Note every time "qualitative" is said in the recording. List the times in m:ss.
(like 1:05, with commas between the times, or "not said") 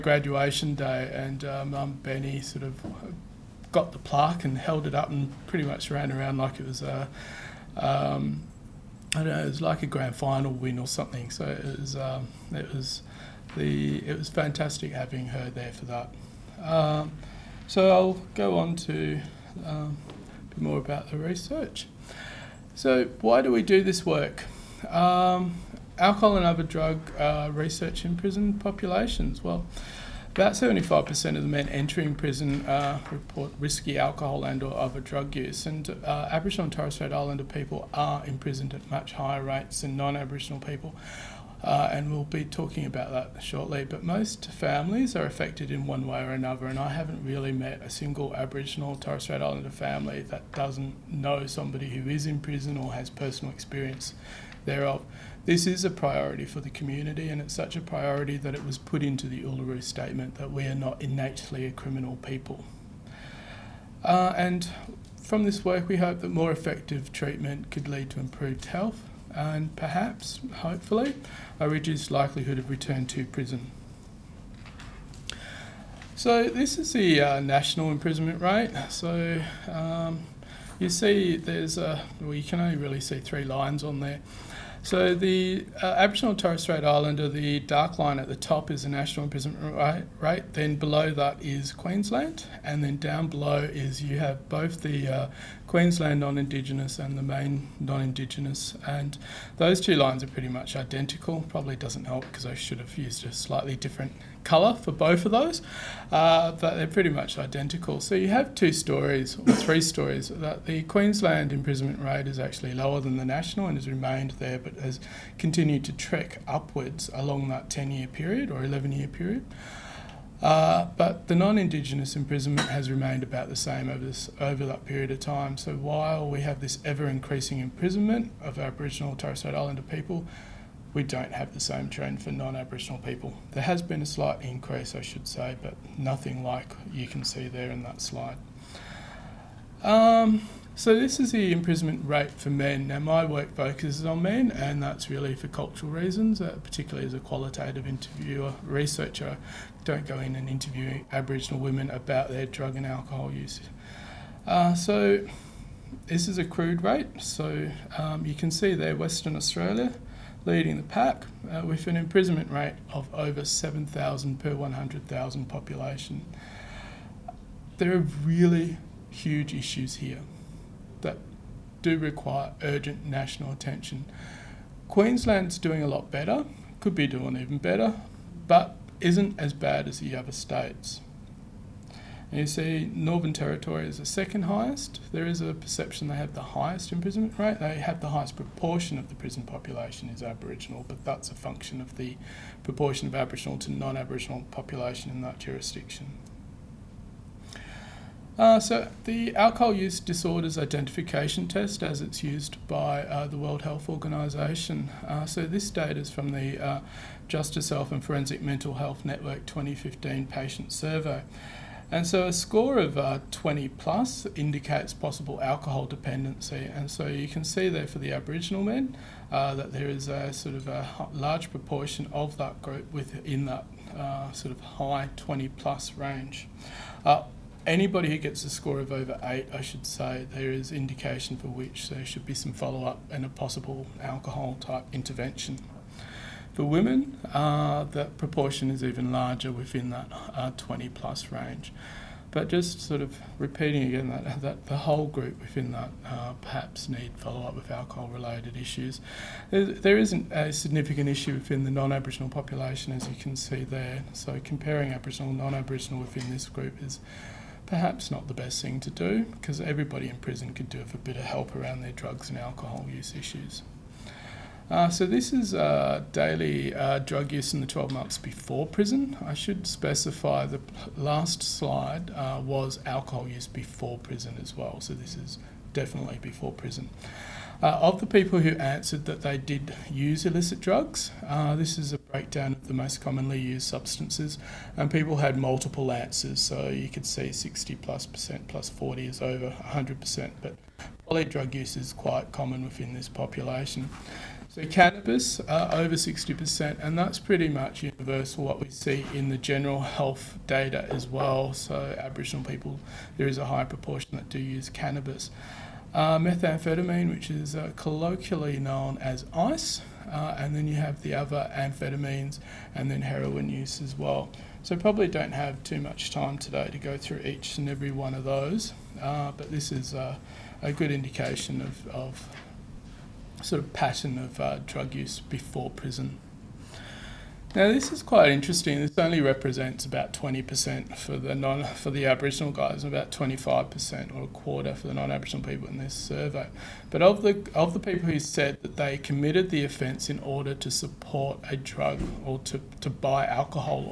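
2:27.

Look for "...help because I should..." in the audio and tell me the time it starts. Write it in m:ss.
1:42.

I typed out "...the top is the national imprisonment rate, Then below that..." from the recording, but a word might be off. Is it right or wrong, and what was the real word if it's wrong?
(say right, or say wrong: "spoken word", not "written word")
right.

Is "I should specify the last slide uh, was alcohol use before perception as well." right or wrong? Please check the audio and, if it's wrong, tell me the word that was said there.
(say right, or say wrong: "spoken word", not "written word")
wrong: "prison", not "perception".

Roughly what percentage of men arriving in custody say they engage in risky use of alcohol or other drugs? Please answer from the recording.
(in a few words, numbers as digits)
75%.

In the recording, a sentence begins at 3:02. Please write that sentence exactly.
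And you see Northern Territory is the second highest.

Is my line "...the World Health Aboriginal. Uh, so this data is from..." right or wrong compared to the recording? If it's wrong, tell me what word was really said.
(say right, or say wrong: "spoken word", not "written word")
wrong: "Organization", not "Aboriginal".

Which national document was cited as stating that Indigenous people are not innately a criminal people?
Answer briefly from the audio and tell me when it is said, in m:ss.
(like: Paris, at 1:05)
Uluru Statement, at 0:59.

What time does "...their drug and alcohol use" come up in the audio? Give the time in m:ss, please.
2:32.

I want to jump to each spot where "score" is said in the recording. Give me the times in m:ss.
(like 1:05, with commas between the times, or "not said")
3:32, 3:48.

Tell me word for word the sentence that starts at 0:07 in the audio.
Um, I know, it was like a grand final win or something.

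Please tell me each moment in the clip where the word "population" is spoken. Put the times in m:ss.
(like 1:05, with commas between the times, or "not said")
0:28, 2:45, 3:09, 3:14, 4:12, 4:53.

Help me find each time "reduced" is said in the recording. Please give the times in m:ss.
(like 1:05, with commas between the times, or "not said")
1:11.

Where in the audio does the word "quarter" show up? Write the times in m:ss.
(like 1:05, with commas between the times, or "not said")
5:34.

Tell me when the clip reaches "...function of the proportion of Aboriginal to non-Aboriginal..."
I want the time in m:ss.
3:11.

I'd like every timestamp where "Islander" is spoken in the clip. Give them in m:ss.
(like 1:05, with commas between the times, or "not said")
0:37, 0:49, 1:26, 2:09.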